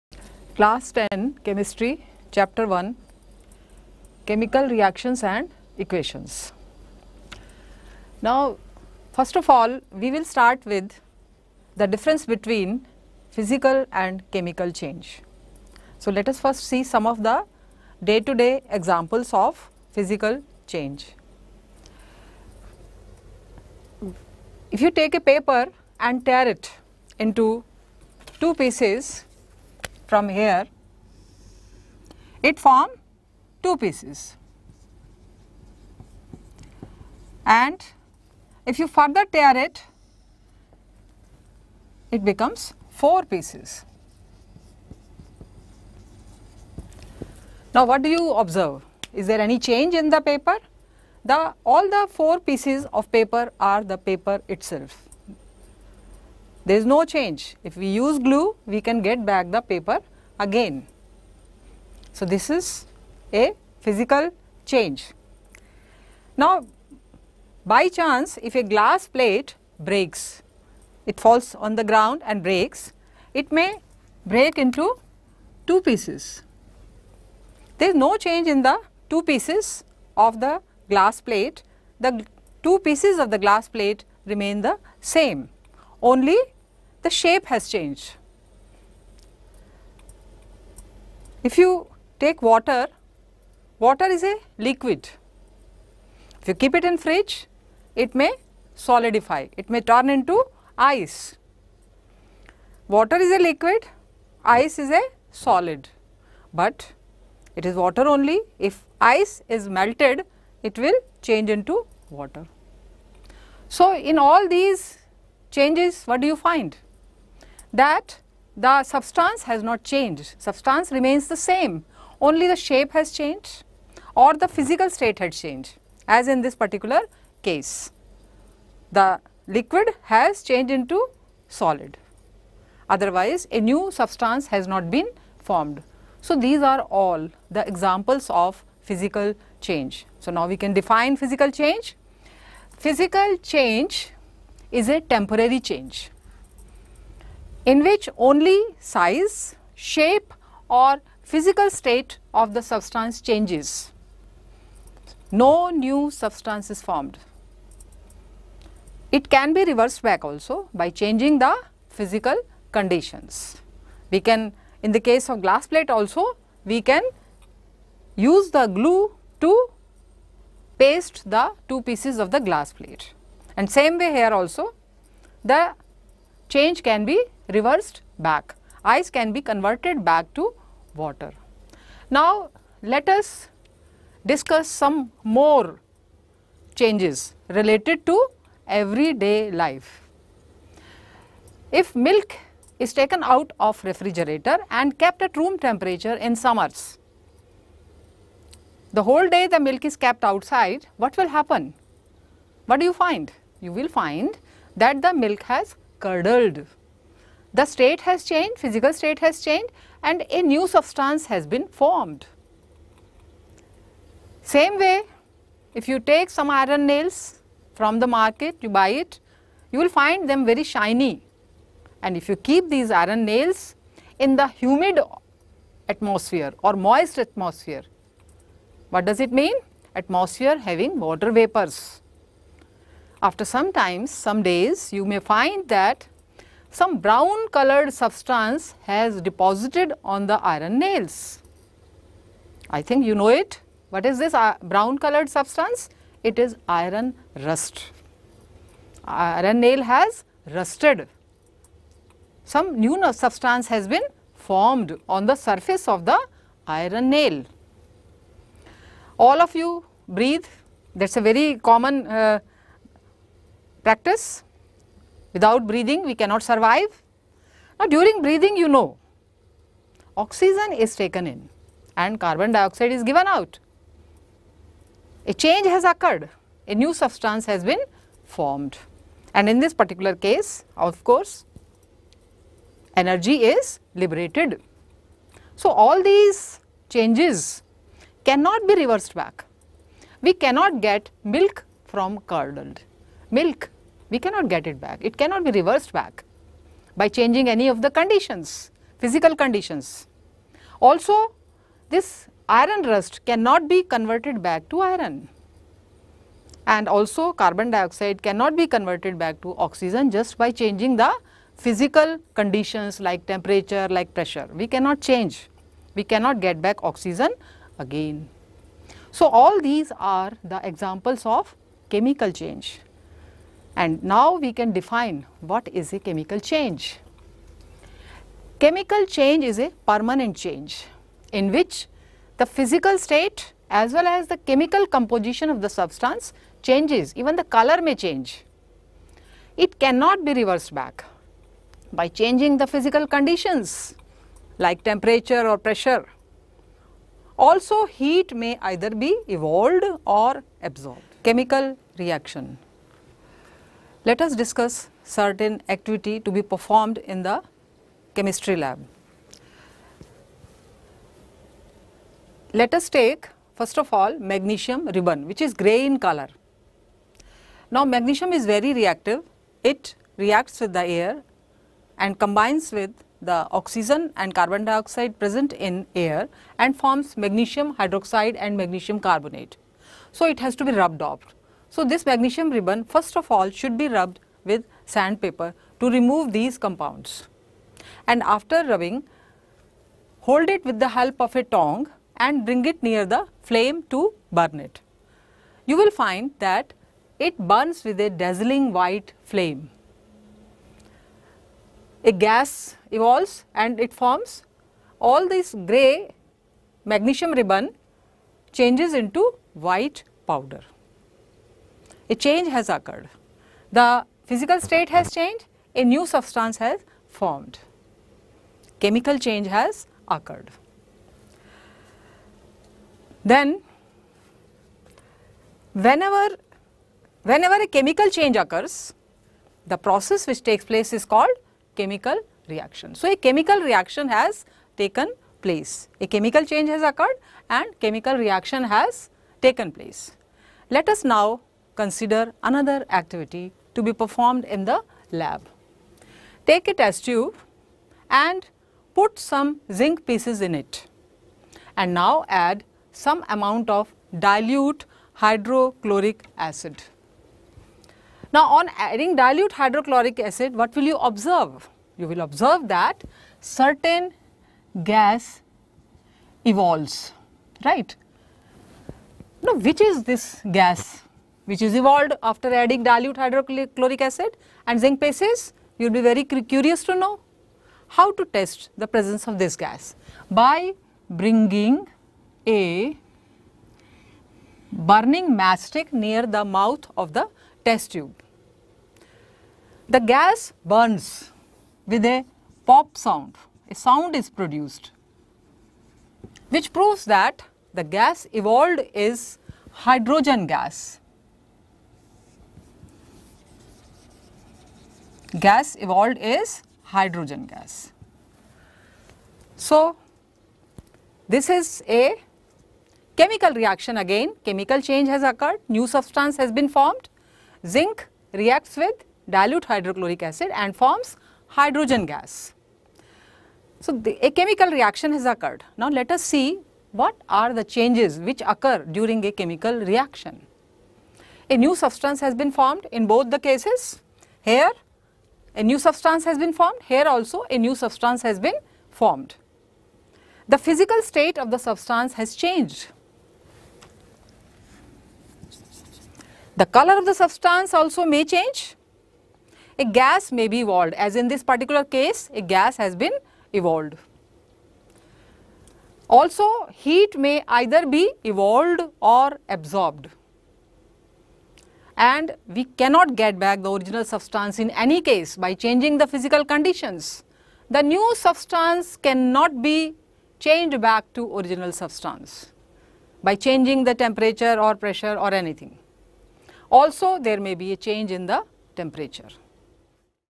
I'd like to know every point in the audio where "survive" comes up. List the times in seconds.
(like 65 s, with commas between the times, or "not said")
266 s.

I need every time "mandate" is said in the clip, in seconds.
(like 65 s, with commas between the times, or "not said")
not said.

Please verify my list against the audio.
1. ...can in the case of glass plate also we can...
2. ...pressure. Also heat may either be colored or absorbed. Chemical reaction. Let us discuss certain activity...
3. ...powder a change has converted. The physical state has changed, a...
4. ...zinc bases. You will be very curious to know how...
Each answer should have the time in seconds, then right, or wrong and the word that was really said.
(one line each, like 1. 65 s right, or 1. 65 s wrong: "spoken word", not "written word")
1. 164 s right
2. 345 s wrong: "evolved", not "colored"
3. 410 s wrong: "occurred", not "converted"
4. 474 s right.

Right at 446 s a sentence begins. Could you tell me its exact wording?
Take a test tube and put some zinc pieces in it and now add some amount of dilute hydrochloric acid.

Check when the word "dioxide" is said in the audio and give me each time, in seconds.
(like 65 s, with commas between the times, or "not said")
272 s, 307 s, 374 s.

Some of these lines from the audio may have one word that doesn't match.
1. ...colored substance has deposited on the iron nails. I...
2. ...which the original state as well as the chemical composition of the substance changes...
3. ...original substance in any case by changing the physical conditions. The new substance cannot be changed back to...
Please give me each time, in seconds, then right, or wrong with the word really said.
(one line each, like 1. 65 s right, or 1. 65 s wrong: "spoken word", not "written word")
1. 237 s right
2. 331 s wrong: "physical", not "original"
3. 563 s right.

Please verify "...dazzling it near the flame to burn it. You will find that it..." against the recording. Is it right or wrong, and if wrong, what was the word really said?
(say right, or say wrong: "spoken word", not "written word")
wrong: "bring", not "dazzling".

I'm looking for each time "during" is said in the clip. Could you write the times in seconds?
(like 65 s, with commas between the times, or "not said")
267 s, 528 s.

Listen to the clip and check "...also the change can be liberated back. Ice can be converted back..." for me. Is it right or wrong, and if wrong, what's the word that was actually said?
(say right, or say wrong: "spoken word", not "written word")
wrong: "reversed", not "liberated".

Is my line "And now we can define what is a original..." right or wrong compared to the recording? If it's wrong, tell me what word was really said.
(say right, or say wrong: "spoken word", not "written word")
wrong: "chemical", not "original".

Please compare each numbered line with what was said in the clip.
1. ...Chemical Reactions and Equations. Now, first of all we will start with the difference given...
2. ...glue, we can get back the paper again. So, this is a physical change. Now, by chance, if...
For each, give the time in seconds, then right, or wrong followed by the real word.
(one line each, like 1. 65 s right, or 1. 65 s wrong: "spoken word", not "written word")
1. 4 s wrong: "between", not "given"
2. 58 s right.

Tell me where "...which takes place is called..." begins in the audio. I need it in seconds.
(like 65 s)
430 s.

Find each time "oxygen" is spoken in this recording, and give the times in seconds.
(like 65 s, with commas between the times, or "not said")
270 s, 309 s, 316 s, 373 s.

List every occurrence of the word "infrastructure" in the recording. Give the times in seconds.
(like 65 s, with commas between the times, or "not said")
not said.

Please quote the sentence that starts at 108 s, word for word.
If ice is melted, it will change into water.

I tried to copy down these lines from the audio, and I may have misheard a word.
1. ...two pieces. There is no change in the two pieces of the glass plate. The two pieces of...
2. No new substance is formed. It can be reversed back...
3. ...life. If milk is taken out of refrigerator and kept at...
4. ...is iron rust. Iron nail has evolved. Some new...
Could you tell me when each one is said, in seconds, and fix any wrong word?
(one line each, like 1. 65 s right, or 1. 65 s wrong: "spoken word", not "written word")
1. 75 s right
2. 155 s right
3. 189 s right
4. 246 s wrong: "rusted", not "evolved".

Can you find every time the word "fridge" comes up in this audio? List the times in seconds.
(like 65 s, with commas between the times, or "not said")
96 s.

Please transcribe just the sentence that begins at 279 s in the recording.
And in this particular case, of course, energy is liberated.